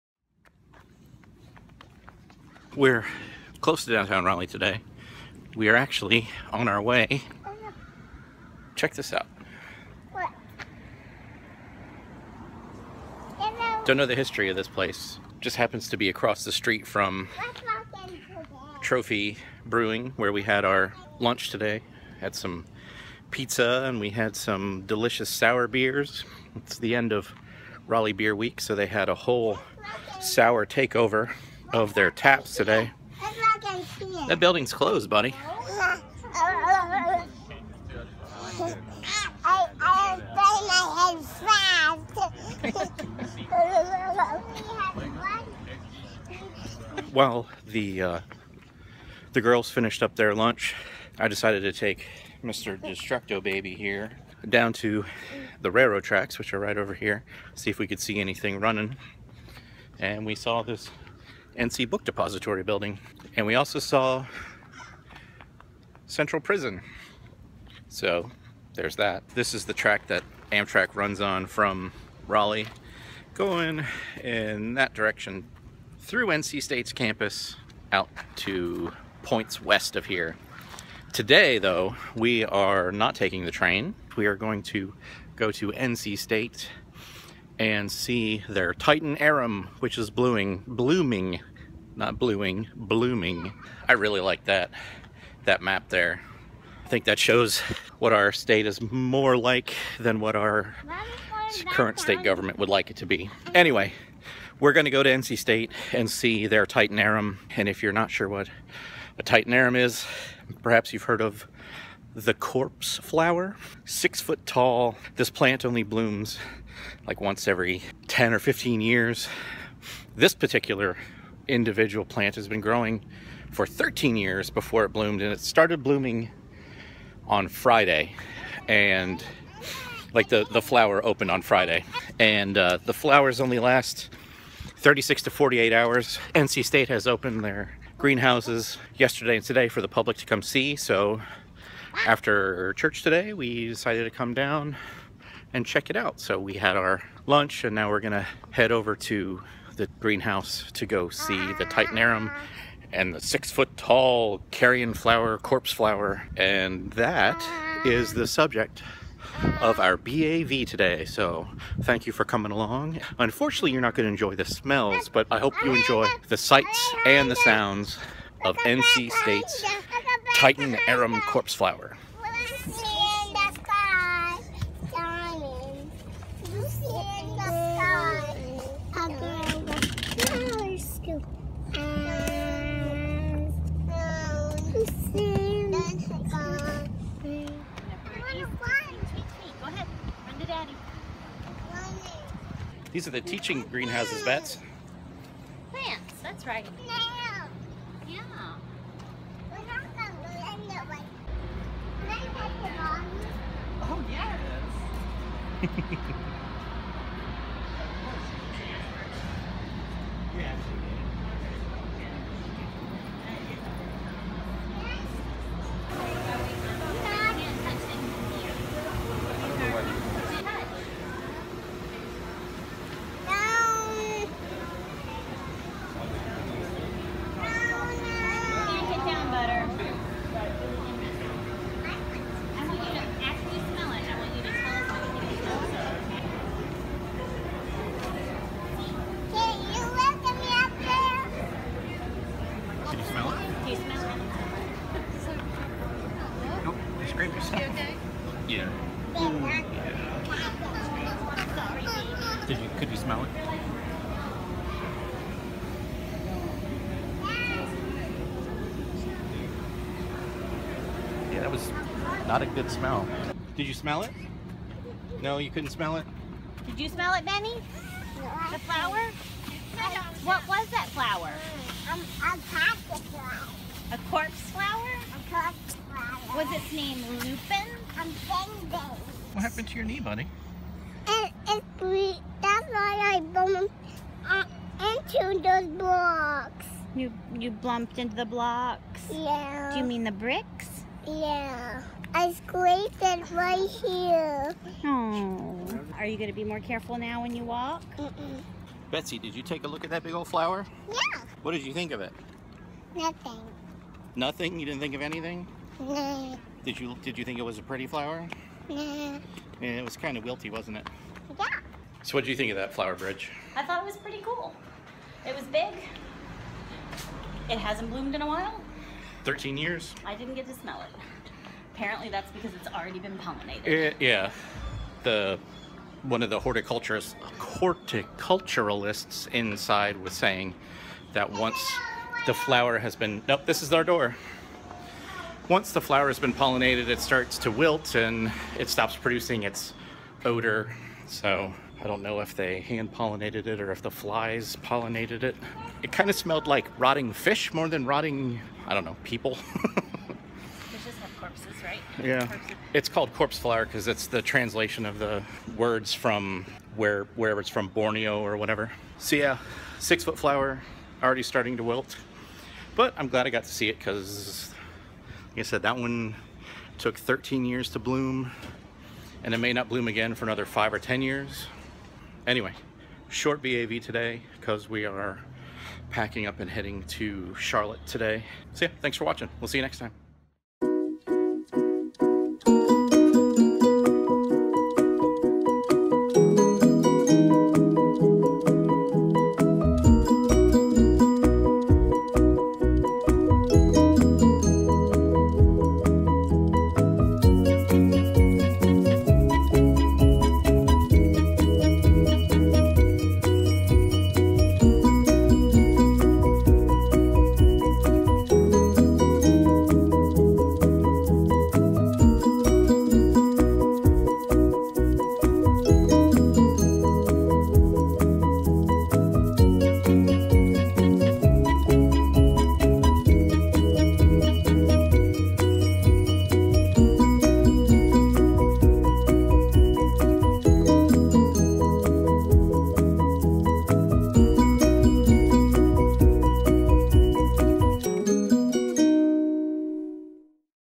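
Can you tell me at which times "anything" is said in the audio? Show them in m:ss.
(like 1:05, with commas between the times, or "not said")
0:58, 5:05.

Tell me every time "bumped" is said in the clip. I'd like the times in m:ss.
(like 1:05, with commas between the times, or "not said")
4:43, 4:47.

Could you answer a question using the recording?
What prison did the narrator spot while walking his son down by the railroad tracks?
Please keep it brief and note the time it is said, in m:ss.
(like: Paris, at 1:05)
Central Prison, at 1:06.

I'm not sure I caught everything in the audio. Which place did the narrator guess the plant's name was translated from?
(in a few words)
Borneo.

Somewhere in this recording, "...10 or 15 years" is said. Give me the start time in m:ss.
1:58.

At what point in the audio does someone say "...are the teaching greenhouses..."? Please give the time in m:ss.
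3:13.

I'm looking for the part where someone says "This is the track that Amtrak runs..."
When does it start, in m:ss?
1:09.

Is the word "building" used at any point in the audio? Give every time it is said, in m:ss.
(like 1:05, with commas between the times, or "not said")
0:34, 1:02.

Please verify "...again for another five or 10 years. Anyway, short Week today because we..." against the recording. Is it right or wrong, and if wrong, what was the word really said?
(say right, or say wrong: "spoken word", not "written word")
wrong: "BAV", not "Week".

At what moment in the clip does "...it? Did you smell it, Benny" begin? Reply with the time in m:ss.
4:25.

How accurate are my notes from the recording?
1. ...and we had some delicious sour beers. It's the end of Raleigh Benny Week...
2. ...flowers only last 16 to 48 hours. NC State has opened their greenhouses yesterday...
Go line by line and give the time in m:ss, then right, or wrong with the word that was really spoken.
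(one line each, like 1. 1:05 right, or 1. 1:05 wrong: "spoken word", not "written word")
1. 0:23 wrong: "Beer", not "Benny"
2. 2:12 wrong: "36", not "16".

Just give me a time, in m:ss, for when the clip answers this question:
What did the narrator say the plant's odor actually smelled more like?
5:46.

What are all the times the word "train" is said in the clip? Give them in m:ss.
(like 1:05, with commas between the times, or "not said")
1:23.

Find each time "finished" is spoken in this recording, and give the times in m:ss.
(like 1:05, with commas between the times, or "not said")
0:49.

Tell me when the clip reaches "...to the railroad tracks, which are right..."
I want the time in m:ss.
0:54.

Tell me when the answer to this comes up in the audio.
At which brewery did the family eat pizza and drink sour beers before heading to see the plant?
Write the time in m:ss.
0:18.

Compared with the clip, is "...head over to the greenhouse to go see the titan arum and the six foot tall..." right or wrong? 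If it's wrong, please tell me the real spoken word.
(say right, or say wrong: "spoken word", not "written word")
right.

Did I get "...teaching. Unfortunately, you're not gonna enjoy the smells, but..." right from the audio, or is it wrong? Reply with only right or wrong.
wrong.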